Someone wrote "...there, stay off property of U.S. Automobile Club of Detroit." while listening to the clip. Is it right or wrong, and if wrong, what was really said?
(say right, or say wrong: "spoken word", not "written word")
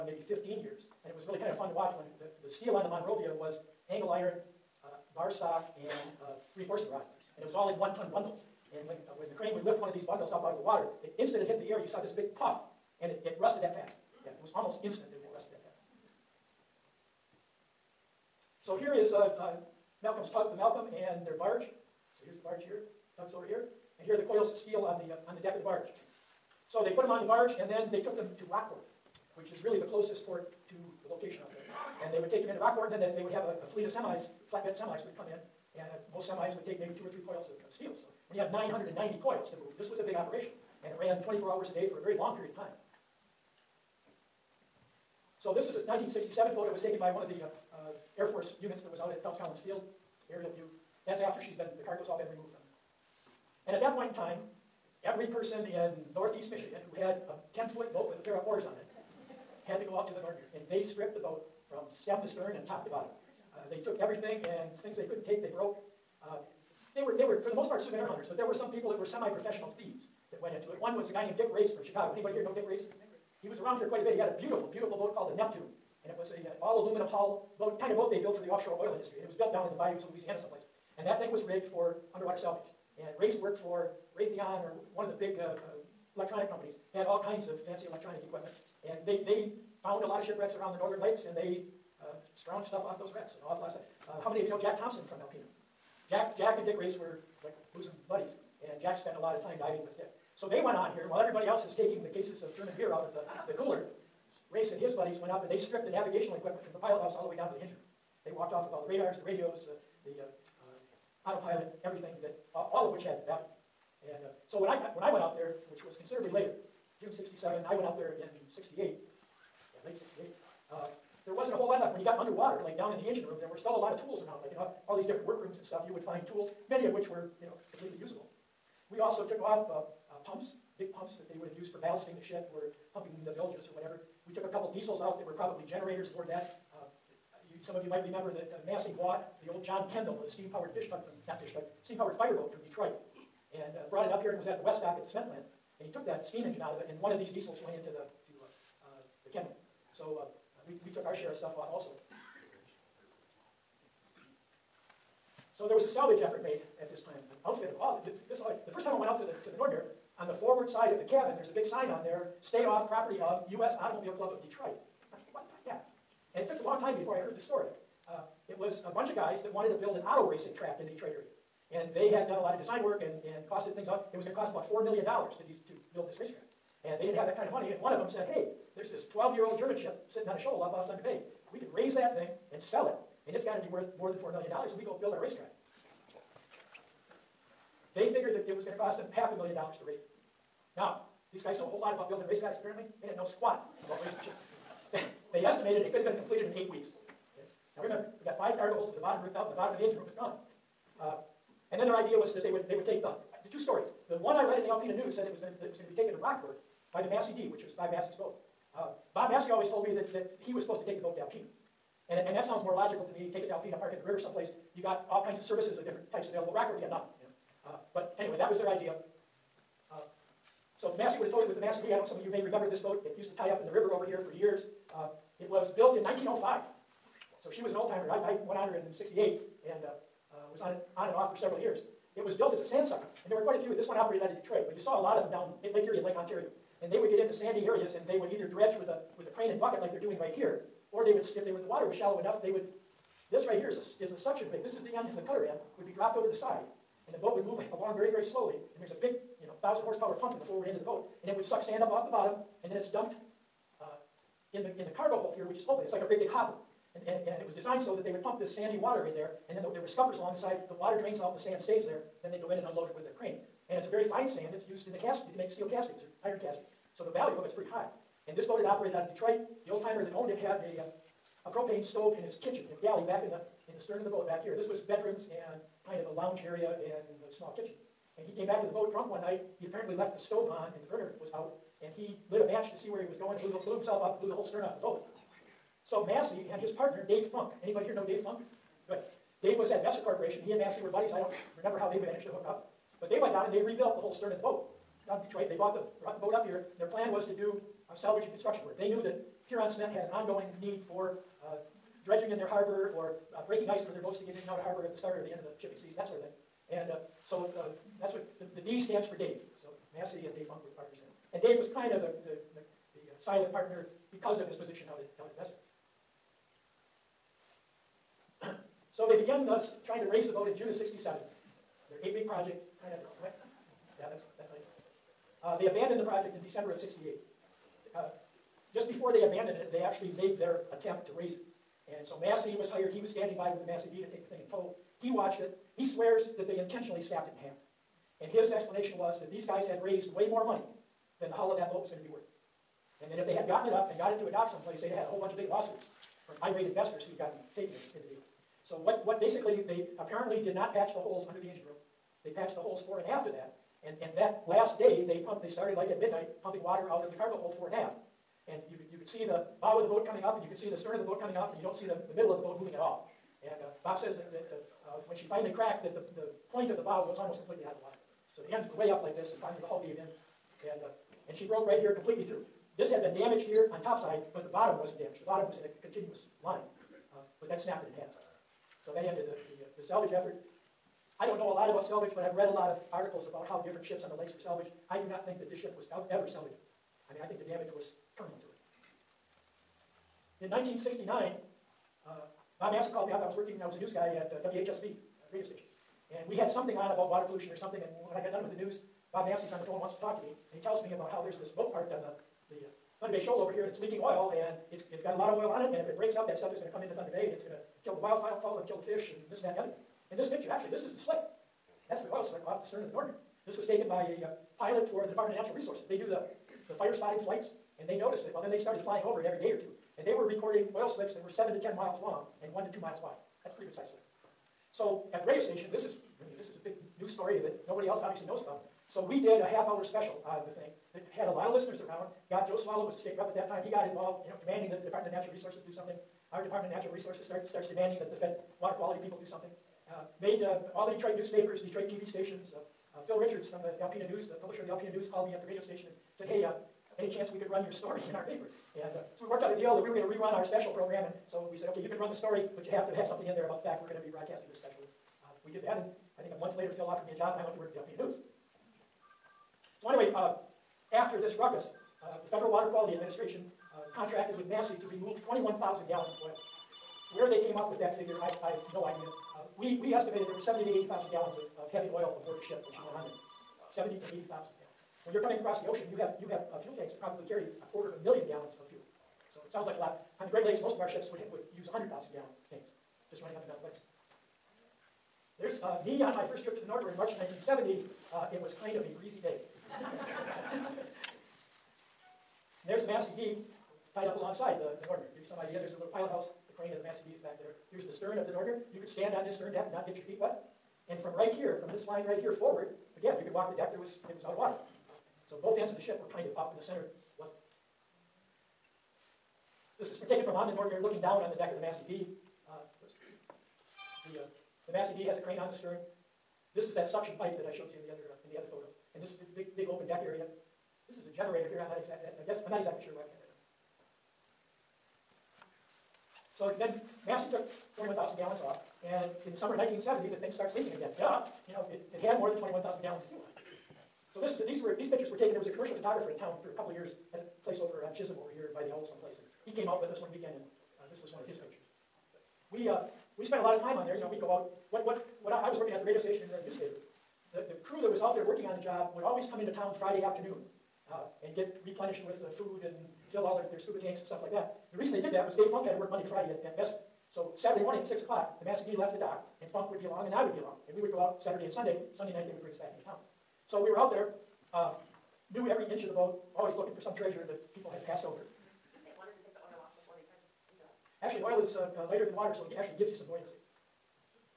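right.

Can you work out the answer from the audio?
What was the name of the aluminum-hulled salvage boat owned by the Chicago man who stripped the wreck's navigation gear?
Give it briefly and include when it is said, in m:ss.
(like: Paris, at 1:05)
Neptune, at 1:15.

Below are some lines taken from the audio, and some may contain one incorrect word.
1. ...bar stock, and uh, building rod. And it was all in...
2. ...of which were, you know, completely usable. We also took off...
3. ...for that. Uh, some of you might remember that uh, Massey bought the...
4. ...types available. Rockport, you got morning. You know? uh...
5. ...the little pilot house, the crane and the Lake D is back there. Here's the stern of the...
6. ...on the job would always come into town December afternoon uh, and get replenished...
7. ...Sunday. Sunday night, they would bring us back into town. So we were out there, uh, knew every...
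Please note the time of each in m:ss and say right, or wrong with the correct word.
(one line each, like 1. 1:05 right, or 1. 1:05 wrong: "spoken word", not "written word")
1. 0:05 wrong: "reinforcing", not "building"
2. 2:06 right
3. 2:16 right
4. 3:36 wrong: "nothing", not "morning"
5. 8:15 wrong: "Massey", not "Lake"
6. 9:08 wrong: "Friday", not "December"
7. 9:21 right.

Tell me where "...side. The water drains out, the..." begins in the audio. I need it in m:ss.
4:20.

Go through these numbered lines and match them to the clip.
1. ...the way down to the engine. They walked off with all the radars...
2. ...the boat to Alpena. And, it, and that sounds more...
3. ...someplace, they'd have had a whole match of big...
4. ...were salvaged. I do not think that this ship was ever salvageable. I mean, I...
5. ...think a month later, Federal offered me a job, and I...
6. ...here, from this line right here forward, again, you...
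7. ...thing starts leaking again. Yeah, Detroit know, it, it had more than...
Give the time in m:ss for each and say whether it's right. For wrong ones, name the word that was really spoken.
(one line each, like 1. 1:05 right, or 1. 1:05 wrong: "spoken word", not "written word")
1. 1:47 right
2. 3:30 right
3. 5:44 wrong: "bunch", not "match"
4. 6:24 right
5. 7:36 wrong: "Phil", not "Federal"
6. 8:21 right
7. 8:50 wrong: "You", not "Detroit".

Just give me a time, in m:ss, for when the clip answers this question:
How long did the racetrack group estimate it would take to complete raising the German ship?
3:16.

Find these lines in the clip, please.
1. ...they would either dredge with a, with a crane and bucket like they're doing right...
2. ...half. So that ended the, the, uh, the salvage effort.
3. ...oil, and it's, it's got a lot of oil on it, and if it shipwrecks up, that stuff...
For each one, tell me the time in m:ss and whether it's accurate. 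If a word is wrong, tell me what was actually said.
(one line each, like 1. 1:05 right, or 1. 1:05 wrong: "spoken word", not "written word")
1. 3:58 right
2. 6:18 right
3. 6:43 wrong: "breaks", not "shipwrecks".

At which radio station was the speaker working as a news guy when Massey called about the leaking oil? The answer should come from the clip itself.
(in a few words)
WHSB.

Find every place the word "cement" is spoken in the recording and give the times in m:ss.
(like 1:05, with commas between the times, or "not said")
2:25, 4:59.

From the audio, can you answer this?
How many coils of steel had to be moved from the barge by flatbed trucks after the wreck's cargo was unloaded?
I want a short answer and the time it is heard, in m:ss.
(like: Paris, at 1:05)
990, at 0:38.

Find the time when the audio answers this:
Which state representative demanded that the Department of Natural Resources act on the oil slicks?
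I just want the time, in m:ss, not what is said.
7:12.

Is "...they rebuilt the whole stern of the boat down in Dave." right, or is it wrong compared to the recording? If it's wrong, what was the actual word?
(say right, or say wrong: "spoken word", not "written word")
wrong: "Detroit", not "Dave".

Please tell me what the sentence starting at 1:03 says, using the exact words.
Uh, they took everything and things they couldn't take, they broke.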